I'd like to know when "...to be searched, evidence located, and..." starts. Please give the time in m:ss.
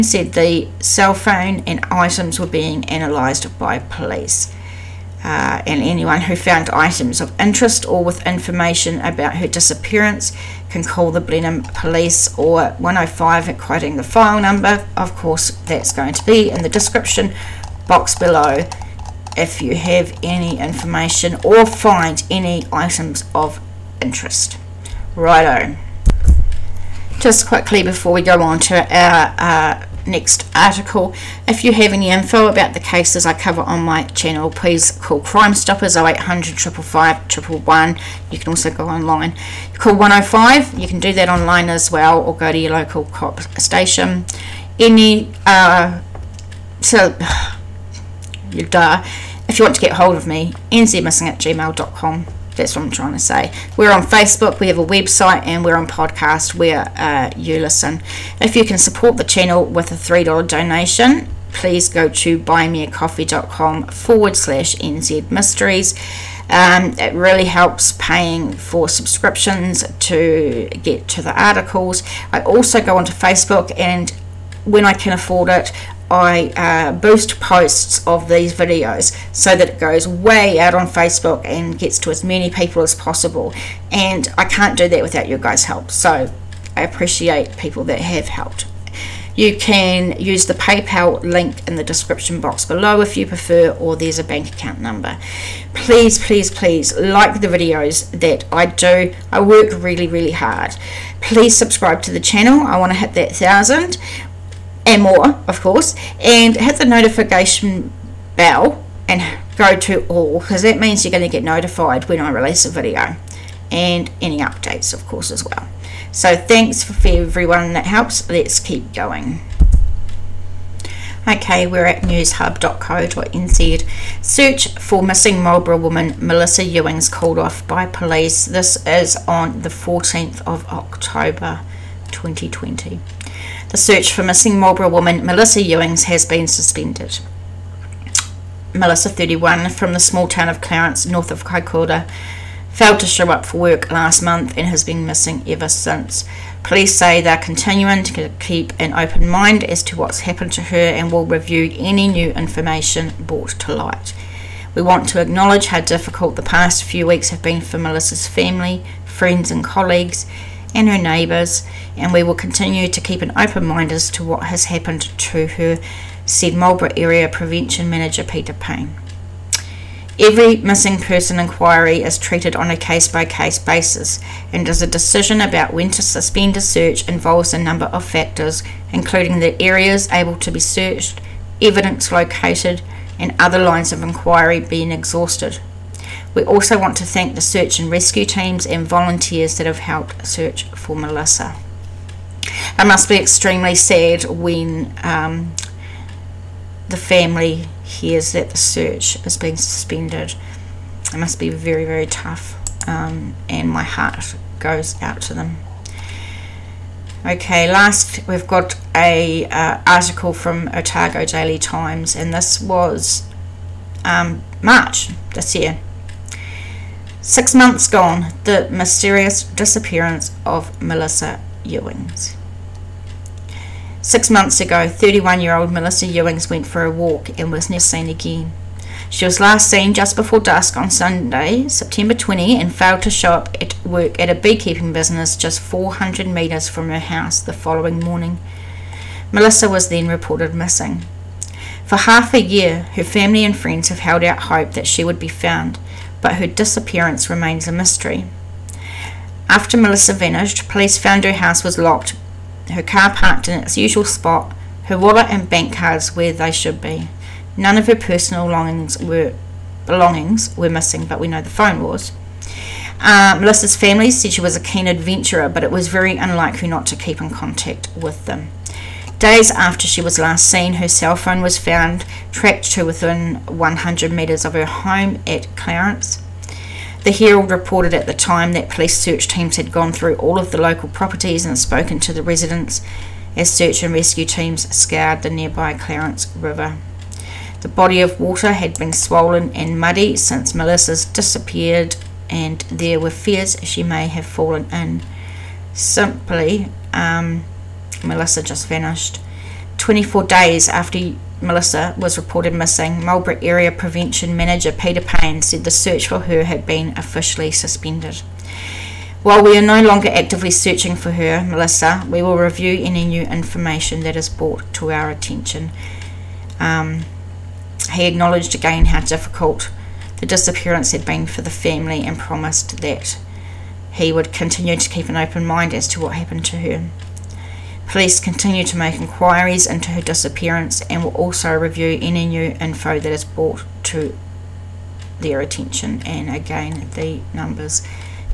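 3:00.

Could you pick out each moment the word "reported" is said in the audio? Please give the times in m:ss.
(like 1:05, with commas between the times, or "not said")
4:00, 4:37, 5:02.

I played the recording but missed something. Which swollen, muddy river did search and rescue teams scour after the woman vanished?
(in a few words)
Clarence River.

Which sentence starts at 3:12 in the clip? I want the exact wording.
I must be extremely sad when um, the family hears that the search is being suspended.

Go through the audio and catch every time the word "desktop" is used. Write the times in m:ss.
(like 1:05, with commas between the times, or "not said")
not said.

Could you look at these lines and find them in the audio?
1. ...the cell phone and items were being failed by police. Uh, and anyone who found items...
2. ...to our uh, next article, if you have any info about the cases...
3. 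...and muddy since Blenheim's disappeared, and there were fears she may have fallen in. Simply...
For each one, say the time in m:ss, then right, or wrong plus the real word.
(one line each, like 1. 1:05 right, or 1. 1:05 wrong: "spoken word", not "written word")
1. 0:00 wrong: "analysed", not "failed"
2. 0:28 right
3. 4:49 wrong: "Melissa", not "Blenheim".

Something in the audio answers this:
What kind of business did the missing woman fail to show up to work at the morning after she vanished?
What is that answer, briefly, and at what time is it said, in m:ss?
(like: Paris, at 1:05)
Beekeeping business, at 3:54.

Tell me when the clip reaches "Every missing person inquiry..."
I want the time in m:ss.
2:50.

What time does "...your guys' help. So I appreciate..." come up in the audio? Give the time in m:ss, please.
1:25.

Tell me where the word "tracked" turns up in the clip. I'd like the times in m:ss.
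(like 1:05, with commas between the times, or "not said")
4:32.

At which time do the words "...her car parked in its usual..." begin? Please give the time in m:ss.
4:12.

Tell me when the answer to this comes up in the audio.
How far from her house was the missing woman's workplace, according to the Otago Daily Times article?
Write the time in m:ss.
3:55.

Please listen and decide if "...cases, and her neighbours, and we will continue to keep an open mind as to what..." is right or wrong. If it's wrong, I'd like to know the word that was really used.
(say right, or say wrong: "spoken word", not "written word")
wrong: "colleagues", not "cases".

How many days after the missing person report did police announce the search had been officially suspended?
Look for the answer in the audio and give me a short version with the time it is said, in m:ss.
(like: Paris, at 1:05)
24, at 4:59.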